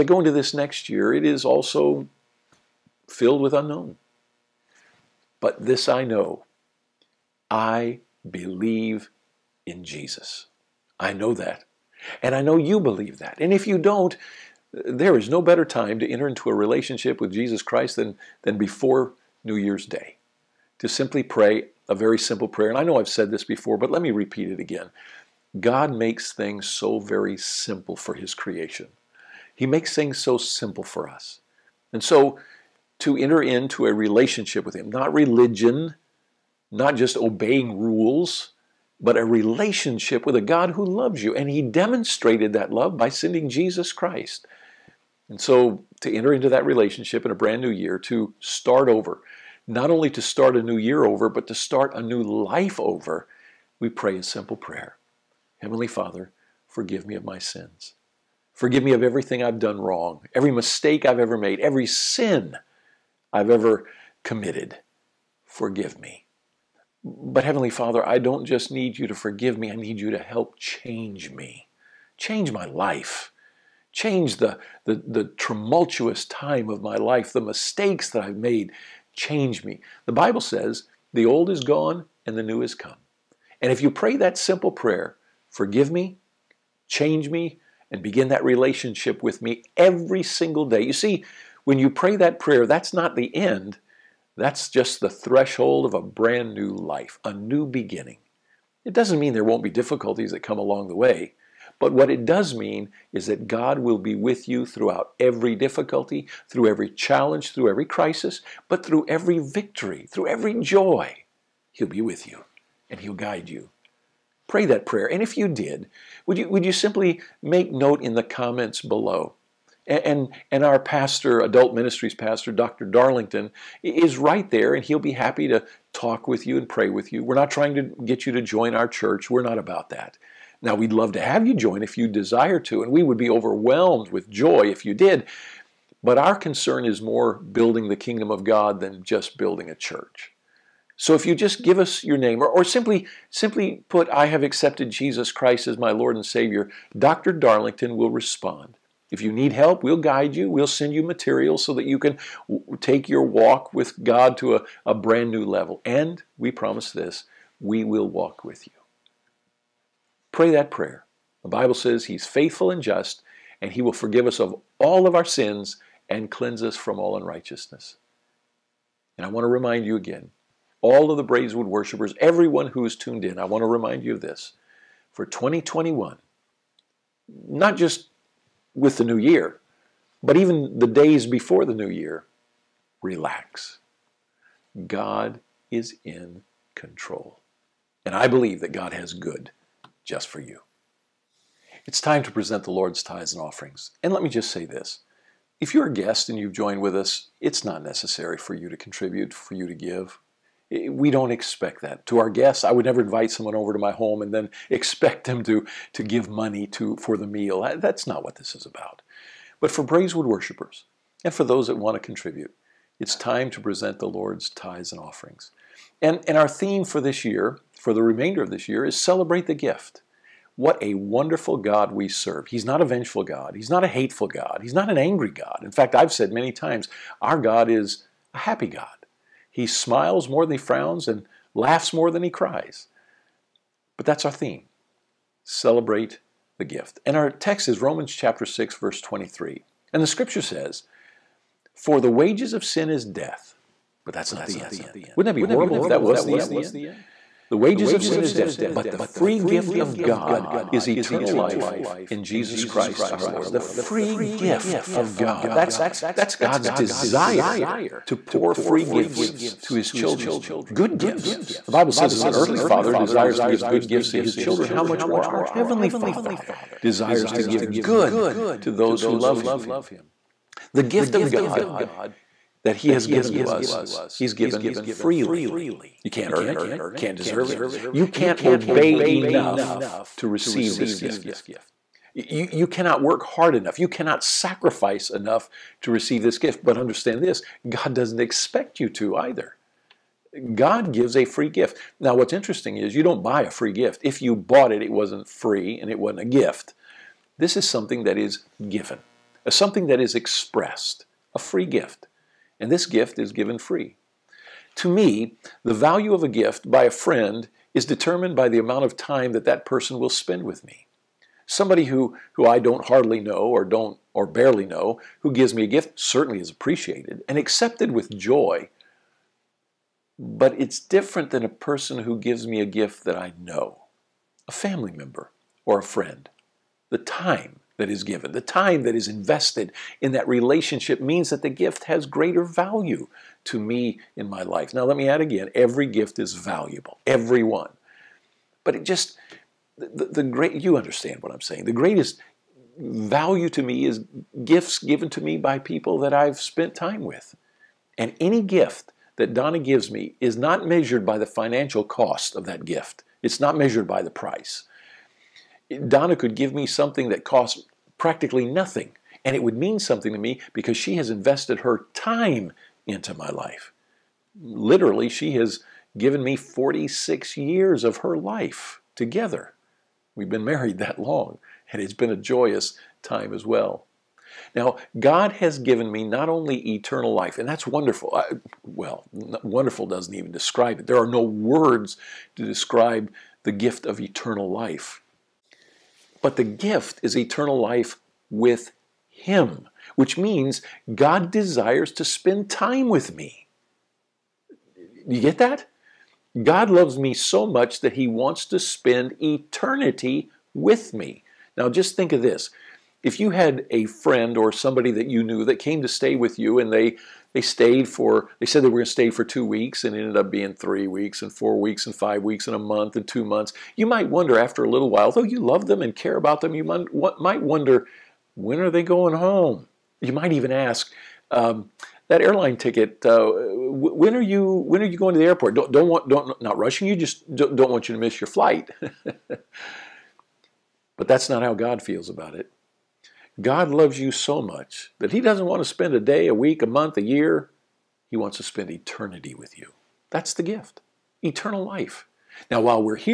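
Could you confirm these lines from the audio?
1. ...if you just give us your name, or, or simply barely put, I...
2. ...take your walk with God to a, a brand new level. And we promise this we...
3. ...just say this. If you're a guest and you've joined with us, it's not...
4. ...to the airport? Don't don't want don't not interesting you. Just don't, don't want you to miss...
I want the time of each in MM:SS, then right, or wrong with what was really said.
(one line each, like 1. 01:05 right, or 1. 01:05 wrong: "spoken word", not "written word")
1. 02:21 wrong: "simply", not "barely"
2. 02:32 right
3. 03:14 right
4. 07:05 wrong: "rushing", not "interesting".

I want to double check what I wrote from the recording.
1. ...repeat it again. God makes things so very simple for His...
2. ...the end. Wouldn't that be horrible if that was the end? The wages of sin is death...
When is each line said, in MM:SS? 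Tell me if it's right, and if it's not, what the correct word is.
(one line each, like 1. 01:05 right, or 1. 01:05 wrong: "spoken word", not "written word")
1. 00:24 right
2. 04:04 right.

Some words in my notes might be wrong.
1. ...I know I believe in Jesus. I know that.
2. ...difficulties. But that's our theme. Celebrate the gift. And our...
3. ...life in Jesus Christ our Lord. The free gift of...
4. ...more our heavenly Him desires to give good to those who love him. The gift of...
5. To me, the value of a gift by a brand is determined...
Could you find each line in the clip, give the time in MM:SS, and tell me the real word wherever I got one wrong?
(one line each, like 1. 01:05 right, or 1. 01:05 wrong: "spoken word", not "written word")
1. 00:05 right
2. 03:52 wrong: "cries", not "difficulties"
3. 04:11 right
4. 04:25 wrong: "Father", not "Him"
5. 05:04 wrong: "friend", not "brand".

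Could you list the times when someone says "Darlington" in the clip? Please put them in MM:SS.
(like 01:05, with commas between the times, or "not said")
02:02, 02:27.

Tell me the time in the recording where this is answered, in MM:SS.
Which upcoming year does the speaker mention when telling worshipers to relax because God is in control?
02:55.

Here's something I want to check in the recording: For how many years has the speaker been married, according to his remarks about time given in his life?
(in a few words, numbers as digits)
46.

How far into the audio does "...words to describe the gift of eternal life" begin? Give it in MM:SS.
06:21.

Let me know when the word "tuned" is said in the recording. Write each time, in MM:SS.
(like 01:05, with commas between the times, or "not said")
02:52.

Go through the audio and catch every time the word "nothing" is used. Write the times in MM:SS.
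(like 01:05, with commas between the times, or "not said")
05:58.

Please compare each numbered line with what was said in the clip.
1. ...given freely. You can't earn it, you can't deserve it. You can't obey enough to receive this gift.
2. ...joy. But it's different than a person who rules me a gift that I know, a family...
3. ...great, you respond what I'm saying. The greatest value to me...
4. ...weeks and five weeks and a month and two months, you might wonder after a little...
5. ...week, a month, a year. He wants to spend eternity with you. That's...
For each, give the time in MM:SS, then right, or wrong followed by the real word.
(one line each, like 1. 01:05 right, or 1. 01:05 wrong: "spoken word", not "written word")
1. 04:34 right
2. 05:18 wrong: "gives", not "rules"
3. 05:40 wrong: "understand", not "respond"
4. 06:51 right
5. 07:16 right.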